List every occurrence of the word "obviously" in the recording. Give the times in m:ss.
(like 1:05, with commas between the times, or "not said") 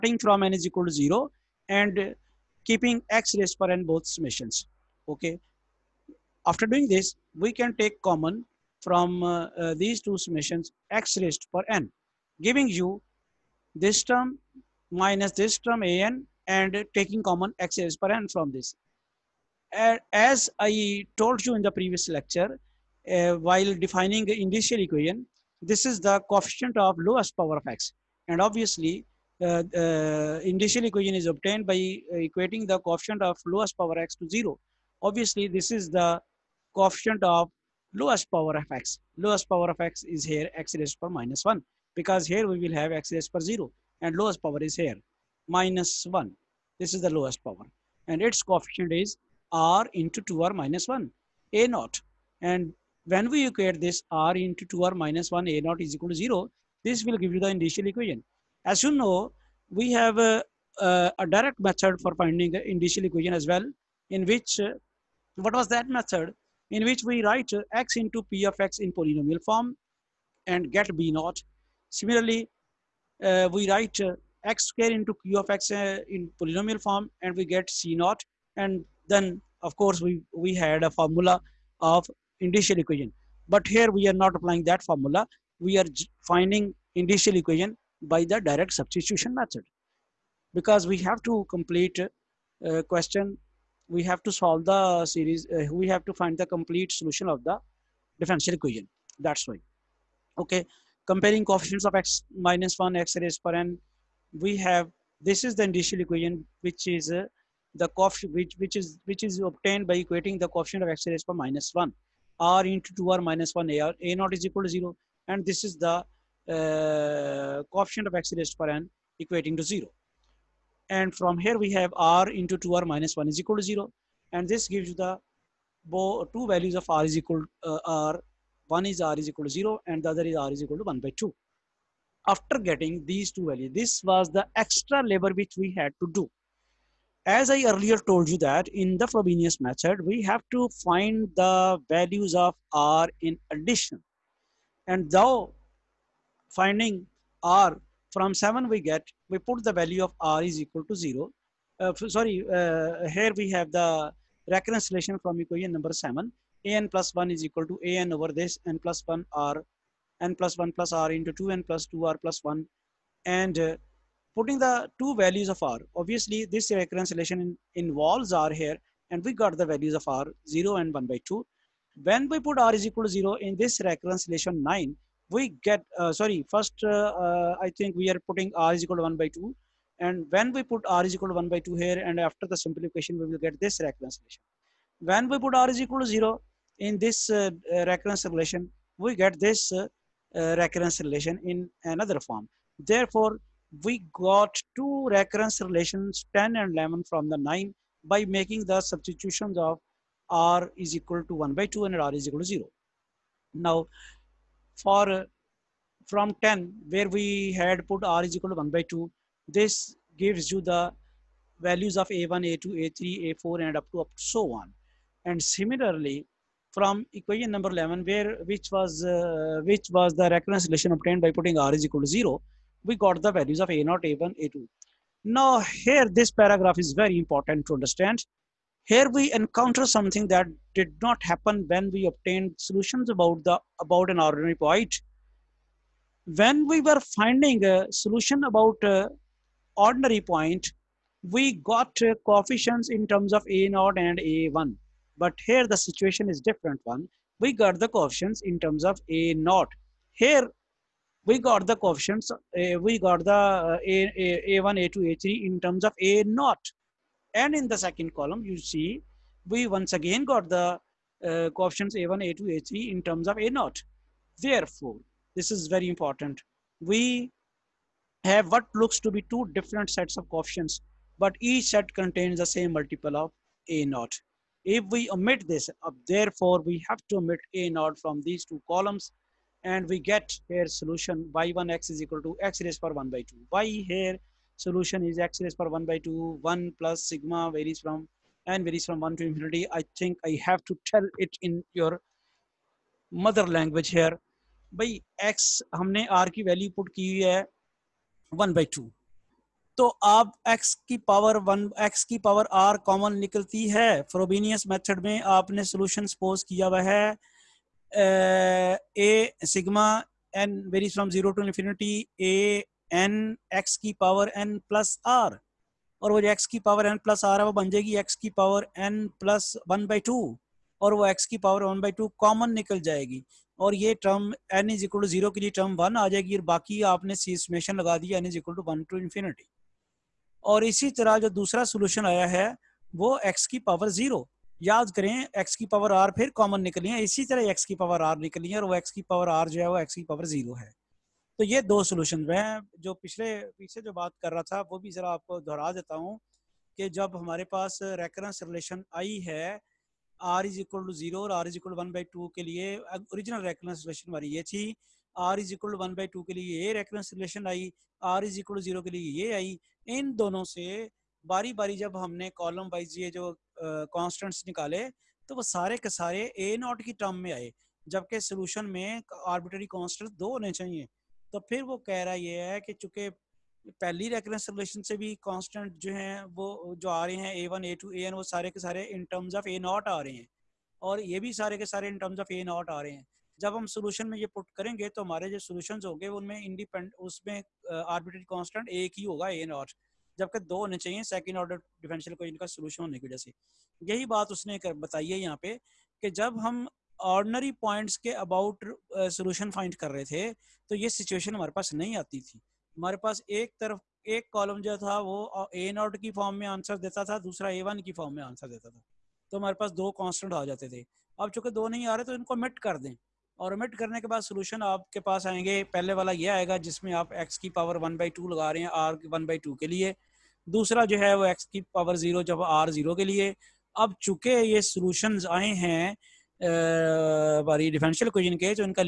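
0:28, 0:35, 2:45.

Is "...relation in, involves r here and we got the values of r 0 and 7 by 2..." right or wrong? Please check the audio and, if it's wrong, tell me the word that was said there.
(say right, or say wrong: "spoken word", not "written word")
wrong: "1", not "7".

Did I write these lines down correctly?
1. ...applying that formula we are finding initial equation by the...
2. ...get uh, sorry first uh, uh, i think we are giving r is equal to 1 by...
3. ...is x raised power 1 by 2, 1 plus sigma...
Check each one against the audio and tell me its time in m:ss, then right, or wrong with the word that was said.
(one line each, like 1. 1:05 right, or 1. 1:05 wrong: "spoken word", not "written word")
1. 1:24 right
2. 2:55 wrong: "putting", not "giving"
3. 4:45 right.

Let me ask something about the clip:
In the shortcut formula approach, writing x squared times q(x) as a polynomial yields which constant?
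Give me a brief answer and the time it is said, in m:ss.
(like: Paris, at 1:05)
c naught, at 1:17.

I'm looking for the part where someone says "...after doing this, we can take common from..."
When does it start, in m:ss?
0:06.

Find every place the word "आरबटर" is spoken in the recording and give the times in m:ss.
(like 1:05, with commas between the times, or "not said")
6:09, 6:27.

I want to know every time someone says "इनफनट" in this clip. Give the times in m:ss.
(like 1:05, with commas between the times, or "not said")
5:11, 5:28.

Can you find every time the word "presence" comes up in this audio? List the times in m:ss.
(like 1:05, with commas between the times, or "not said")
not said.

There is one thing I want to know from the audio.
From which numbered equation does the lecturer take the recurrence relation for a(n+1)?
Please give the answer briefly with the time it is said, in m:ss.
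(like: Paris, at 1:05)
7, at 2:35.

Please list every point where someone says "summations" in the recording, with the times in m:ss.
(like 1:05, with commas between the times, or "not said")
0:04, 0:10.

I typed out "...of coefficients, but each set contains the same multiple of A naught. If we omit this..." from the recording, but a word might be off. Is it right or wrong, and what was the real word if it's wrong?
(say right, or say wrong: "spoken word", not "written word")
right.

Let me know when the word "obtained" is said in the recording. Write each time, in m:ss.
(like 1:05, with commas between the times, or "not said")
0:31, 1:49, 3:40, 3:52.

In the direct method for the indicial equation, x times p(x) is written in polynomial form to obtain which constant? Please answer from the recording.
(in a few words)
b naught.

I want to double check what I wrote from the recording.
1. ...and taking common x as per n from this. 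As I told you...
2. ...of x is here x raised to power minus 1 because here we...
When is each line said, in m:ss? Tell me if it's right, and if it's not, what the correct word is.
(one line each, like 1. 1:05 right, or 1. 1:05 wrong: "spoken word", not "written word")
1. 0:16 right
2. 0:39 right.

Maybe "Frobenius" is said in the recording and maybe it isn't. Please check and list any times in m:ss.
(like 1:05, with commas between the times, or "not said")
2:19.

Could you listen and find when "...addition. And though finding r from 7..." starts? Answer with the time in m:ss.
2:23.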